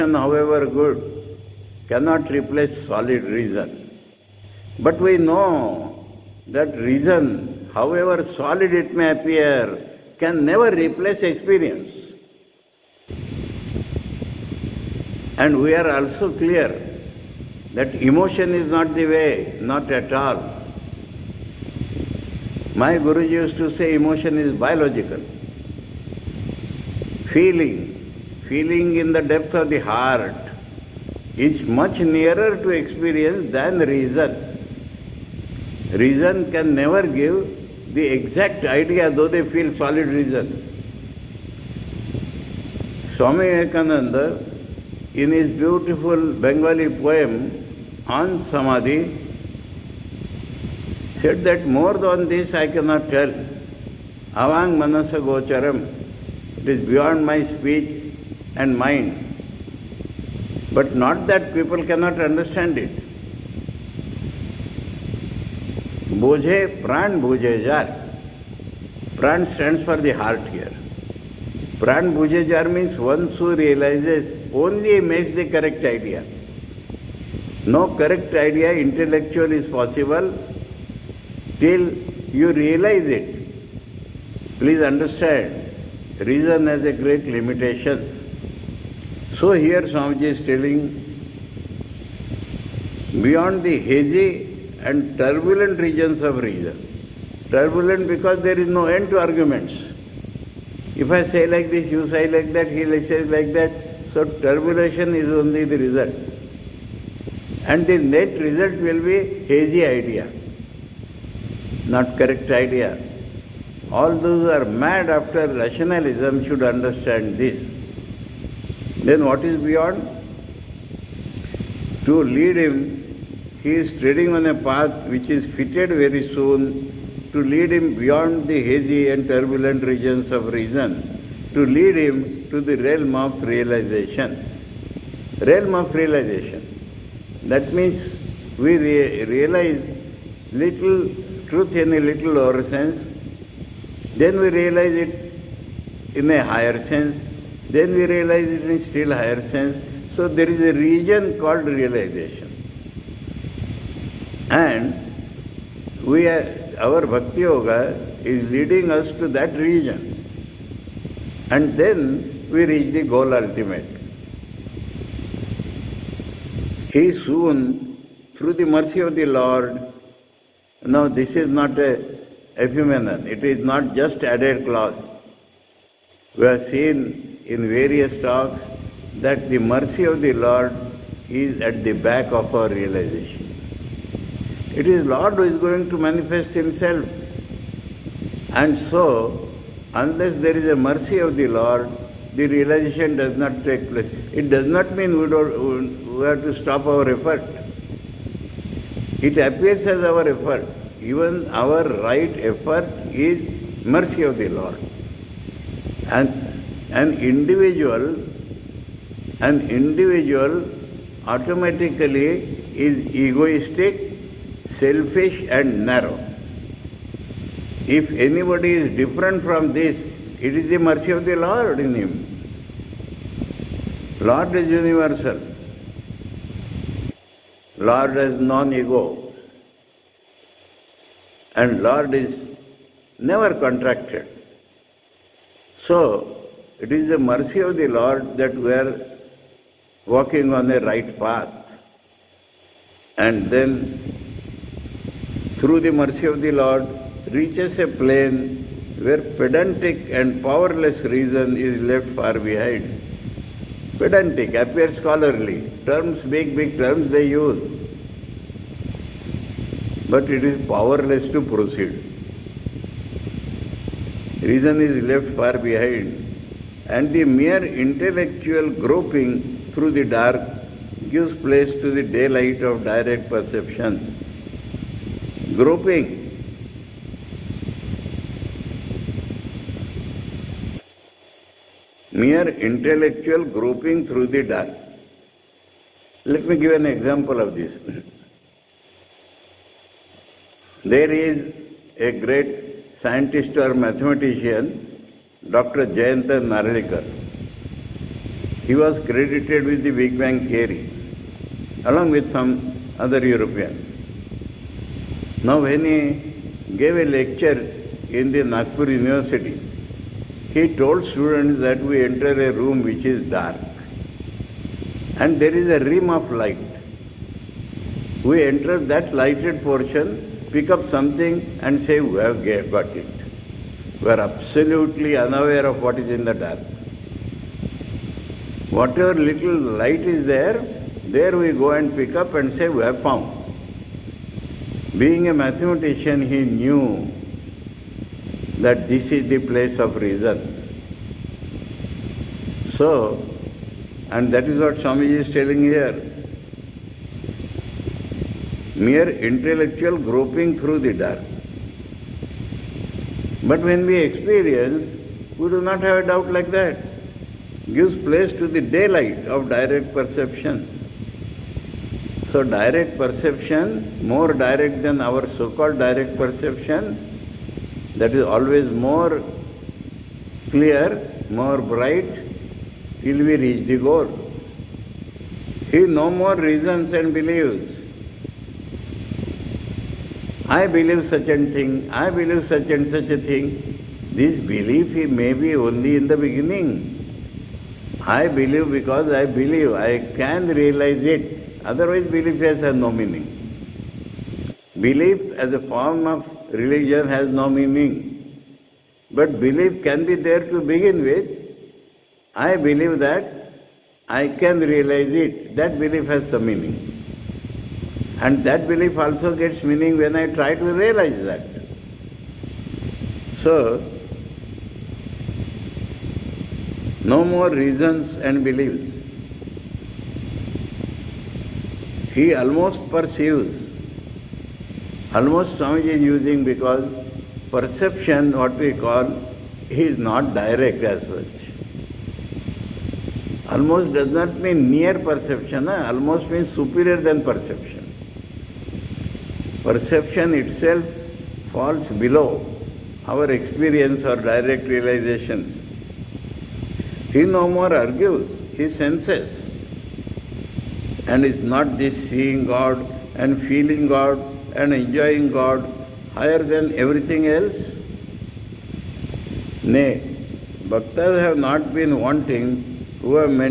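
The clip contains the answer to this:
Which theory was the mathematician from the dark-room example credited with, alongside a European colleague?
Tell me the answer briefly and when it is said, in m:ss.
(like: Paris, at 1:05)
Big Bang theory, at 4:59.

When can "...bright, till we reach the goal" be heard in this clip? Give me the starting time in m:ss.
6:11.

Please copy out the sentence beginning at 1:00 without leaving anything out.
But not that people cannot understand it.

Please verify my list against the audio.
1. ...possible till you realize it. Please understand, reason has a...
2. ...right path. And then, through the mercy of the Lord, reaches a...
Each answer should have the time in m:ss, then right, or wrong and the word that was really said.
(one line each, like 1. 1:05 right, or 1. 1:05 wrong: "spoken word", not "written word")
1. 1:19 right
2. 4:00 right.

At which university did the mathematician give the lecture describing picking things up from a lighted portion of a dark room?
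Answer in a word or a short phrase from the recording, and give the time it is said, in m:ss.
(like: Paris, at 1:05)
Nagpur University, at 5:08.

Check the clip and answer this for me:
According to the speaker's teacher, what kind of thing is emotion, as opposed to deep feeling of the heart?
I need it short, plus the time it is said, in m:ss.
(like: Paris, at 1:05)
Biological, at 0:24.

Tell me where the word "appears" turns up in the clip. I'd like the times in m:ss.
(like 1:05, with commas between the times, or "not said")
0:09, 3:19, 4:14.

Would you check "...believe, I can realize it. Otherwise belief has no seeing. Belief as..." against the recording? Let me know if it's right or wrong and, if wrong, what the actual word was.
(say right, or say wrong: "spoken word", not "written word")
wrong: "meaning", not "seeing".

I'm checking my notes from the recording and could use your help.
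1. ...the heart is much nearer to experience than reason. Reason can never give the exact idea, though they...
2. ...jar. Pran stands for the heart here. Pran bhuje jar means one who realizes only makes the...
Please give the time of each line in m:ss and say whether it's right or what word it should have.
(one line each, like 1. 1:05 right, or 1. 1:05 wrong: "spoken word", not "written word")
1. 0:29 right
2. 1:07 right.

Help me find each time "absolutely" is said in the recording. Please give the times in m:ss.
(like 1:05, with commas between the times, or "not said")
5:24.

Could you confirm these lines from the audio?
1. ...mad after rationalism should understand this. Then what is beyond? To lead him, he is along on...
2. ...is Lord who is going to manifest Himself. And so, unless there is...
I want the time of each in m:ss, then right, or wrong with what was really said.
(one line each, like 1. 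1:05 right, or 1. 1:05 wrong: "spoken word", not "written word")
1. 1:54 wrong: "treading", not "along"
2. 3:04 right.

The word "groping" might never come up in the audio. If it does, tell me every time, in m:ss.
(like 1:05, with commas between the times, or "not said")
4:28, 4:35, 4:43, 5:49.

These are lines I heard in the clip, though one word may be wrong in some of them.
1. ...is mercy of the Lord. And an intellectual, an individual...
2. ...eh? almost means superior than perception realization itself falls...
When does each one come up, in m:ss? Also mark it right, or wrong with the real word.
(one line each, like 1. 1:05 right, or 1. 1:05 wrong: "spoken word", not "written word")
1. 3:23 wrong: "individual", not "intellectual"
2. 7:15 wrong: "perception", not "realization".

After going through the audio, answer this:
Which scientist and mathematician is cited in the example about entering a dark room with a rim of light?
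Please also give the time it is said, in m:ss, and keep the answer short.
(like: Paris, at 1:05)
Jayanta Narlikar, at 4:55.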